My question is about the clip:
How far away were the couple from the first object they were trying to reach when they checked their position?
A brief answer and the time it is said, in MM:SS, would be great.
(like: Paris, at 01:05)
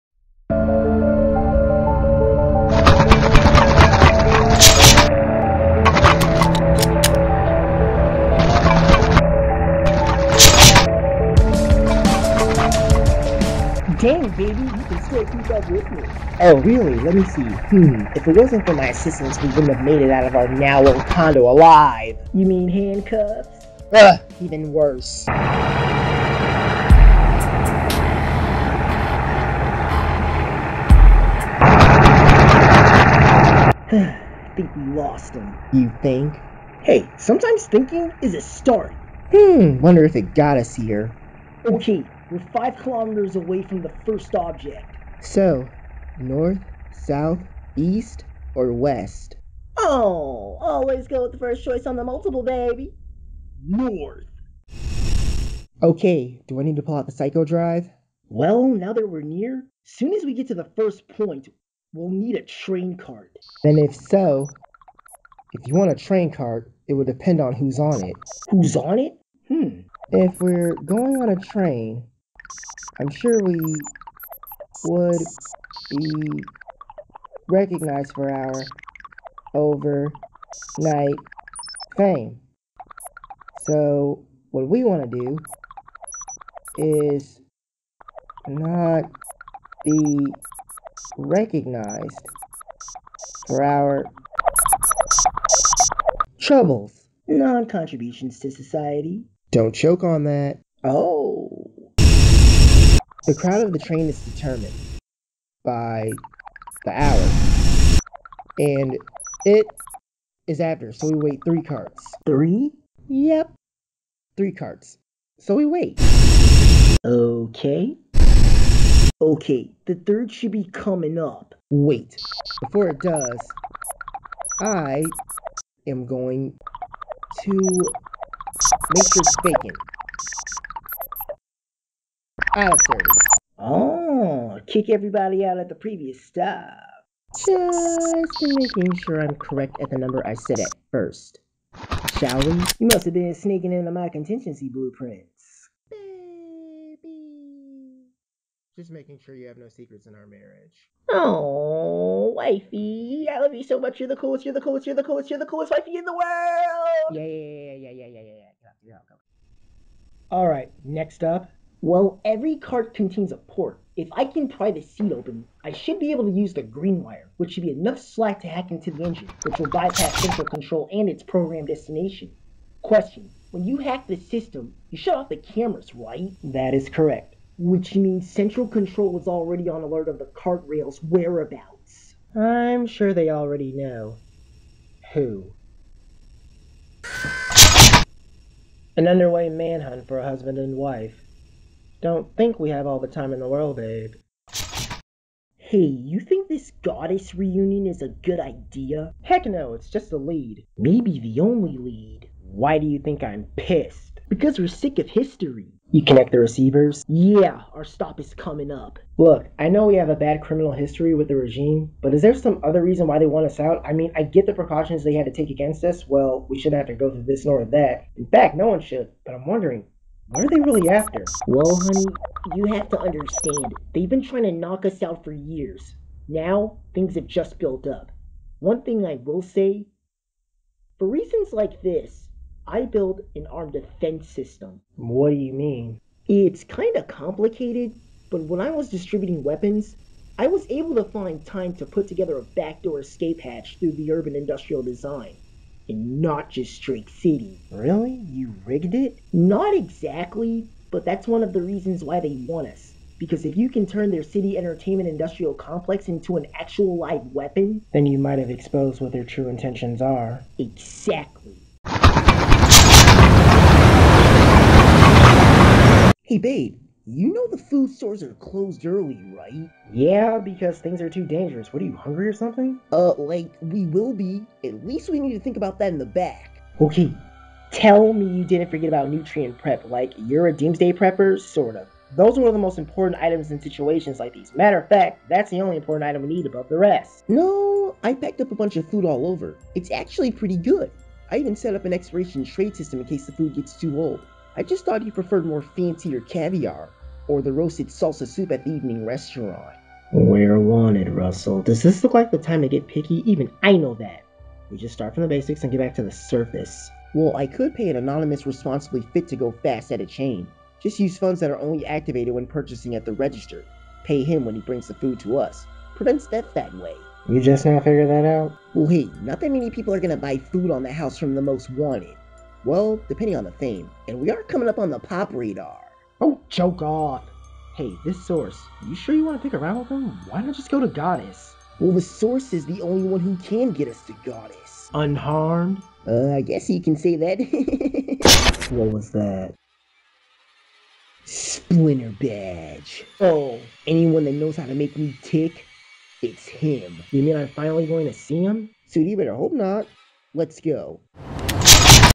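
5 kilometers, at 00:42.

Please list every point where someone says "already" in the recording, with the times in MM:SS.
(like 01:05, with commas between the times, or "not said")
02:59, 03:03.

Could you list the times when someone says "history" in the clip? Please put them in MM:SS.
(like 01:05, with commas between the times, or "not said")
03:25, 03:30.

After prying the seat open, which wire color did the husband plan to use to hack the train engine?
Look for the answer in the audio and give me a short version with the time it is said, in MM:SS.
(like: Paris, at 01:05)
Green, at 02:46.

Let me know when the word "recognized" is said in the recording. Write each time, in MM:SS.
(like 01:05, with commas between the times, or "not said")
01:17, 01:31.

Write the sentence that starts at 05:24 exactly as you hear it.
And we are coming up on the pop radar.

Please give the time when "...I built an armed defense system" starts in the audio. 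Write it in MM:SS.
03:52.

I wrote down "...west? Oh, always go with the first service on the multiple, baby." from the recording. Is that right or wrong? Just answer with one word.
wrong.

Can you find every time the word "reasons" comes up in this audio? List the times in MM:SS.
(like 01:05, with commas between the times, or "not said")
03:32, 03:51, 04:11.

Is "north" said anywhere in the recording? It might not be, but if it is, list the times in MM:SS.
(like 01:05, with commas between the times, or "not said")
00:46, 00:53.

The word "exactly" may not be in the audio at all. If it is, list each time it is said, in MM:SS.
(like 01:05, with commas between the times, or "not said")
04:09, 04:20.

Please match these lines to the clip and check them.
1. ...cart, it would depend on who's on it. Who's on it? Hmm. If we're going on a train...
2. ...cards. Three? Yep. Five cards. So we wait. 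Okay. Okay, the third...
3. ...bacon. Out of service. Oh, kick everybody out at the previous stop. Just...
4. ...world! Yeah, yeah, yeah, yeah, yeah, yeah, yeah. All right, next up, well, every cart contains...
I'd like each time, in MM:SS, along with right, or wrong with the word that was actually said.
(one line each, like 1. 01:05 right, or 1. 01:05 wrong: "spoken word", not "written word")
1. 01:06 right
2. 01:51 wrong: "Three", not "Five"
3. 02:09 right
4. 02:36 right.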